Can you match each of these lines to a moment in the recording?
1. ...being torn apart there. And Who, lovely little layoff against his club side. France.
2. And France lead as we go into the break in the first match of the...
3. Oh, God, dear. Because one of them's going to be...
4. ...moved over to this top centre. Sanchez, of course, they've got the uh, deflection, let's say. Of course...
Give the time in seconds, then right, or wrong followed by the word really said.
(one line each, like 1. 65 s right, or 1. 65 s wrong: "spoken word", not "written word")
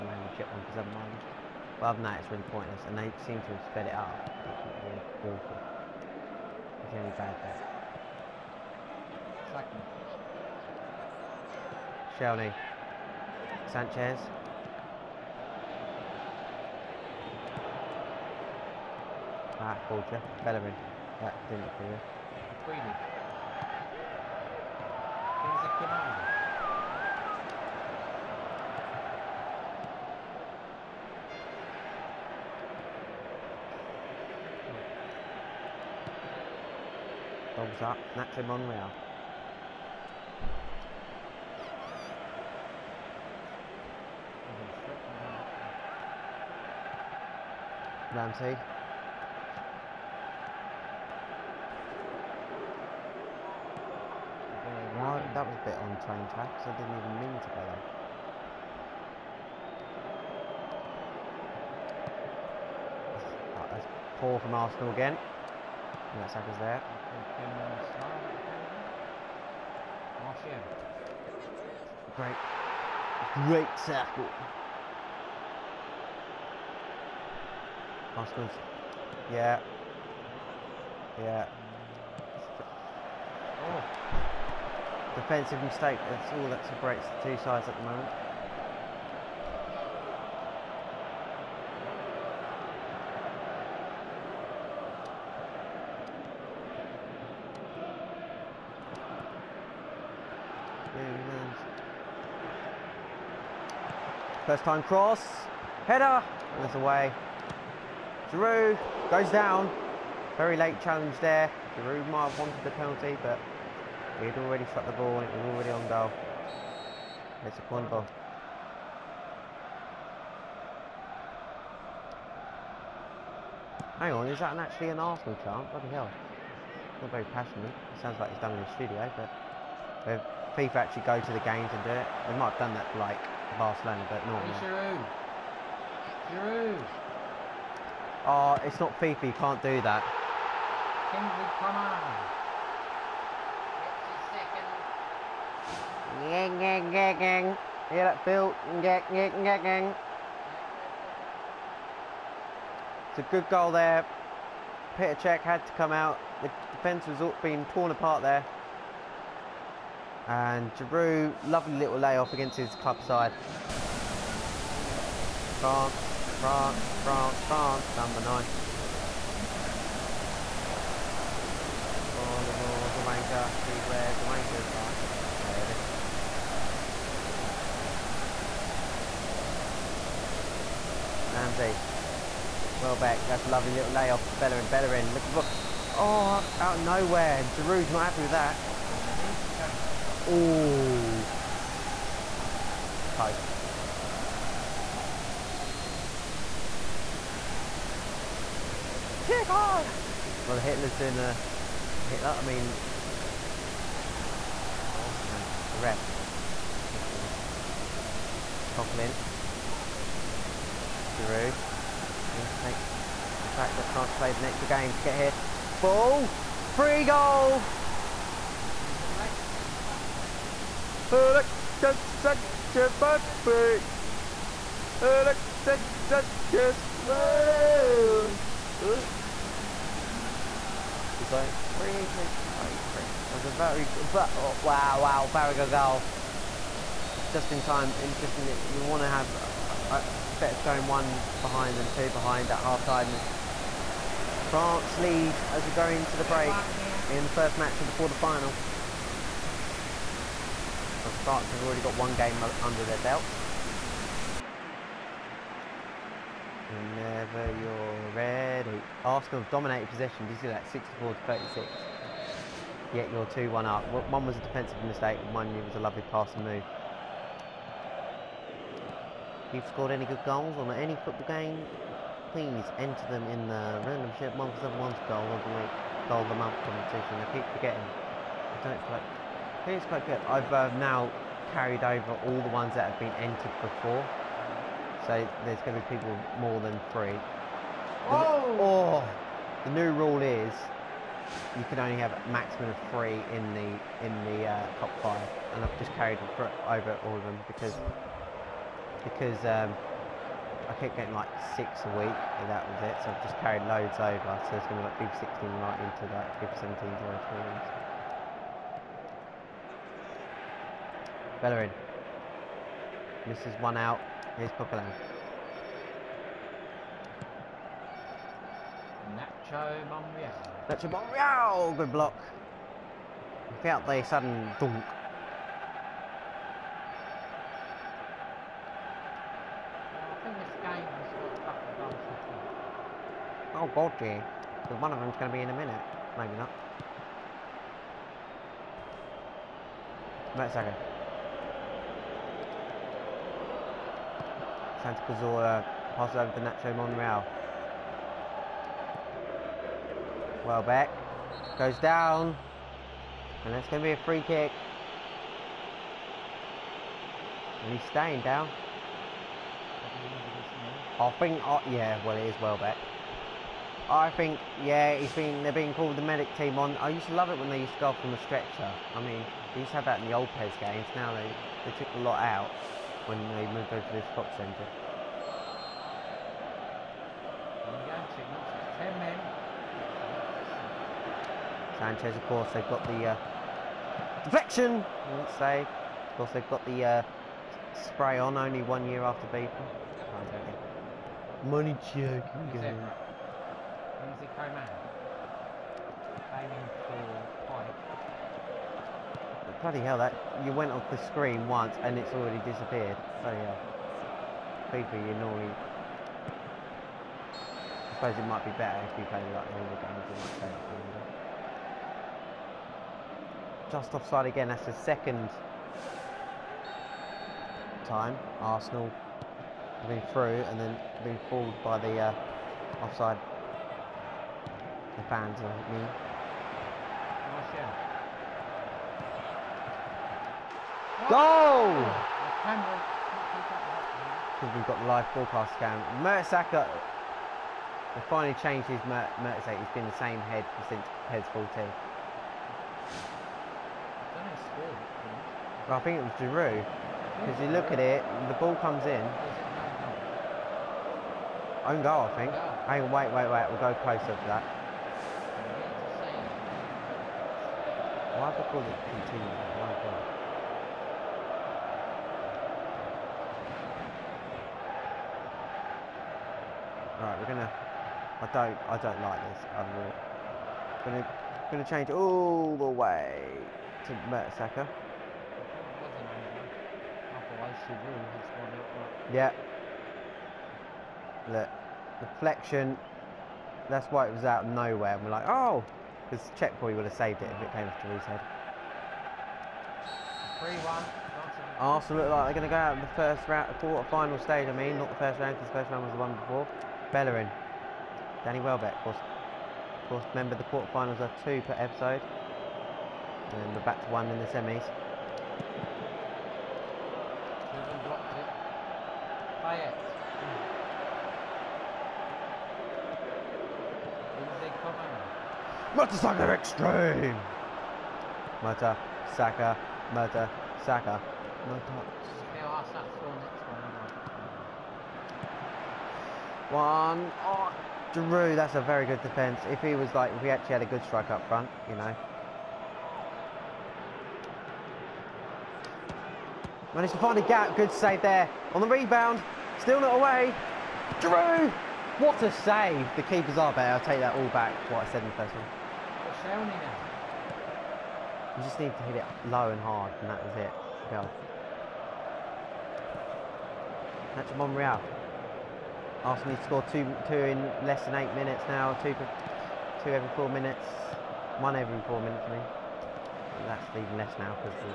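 1. 157 s wrong: "Giroud", not "Who"
2. 243 s right
3. 333 s right
4. 373 s right.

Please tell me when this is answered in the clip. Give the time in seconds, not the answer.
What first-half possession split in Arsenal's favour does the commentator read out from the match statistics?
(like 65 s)
260 s.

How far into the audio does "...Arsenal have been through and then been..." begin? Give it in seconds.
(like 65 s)
418 s.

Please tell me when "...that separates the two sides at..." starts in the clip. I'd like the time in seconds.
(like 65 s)
86 s.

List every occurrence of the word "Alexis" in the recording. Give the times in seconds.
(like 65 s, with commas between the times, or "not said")
219 s, 225 s.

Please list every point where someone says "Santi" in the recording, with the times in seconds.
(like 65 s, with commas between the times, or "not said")
344 s.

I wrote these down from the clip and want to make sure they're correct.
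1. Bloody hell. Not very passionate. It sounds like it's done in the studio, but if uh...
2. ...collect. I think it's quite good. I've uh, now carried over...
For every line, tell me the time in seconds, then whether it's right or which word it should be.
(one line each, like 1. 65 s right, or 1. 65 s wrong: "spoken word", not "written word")
1. 125 s right
2. 278 s right.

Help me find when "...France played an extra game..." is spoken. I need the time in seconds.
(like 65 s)
213 s.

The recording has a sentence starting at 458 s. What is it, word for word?
Why have I called it continue?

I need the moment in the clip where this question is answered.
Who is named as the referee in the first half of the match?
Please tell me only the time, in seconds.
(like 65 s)
208 s.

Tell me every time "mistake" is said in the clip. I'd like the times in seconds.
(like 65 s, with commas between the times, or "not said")
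85 s, 264 s.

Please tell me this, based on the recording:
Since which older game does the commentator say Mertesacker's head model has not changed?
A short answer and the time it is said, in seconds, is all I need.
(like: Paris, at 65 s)
PES 14, at 441 s.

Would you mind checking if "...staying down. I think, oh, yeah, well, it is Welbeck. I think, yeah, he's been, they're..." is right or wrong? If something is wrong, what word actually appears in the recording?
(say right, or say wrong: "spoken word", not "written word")
right.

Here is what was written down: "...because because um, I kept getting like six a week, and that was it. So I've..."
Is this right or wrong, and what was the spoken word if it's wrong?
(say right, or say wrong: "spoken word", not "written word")
right.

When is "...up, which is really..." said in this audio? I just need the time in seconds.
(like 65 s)
3 s.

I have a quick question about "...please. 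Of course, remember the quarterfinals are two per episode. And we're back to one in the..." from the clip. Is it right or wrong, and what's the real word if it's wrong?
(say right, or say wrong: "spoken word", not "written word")
wrong: "course", not "please".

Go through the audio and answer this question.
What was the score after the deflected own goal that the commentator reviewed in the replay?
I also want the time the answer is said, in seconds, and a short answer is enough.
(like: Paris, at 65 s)
3-1, at 490 s.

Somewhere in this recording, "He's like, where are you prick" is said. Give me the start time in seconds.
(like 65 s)
231 s.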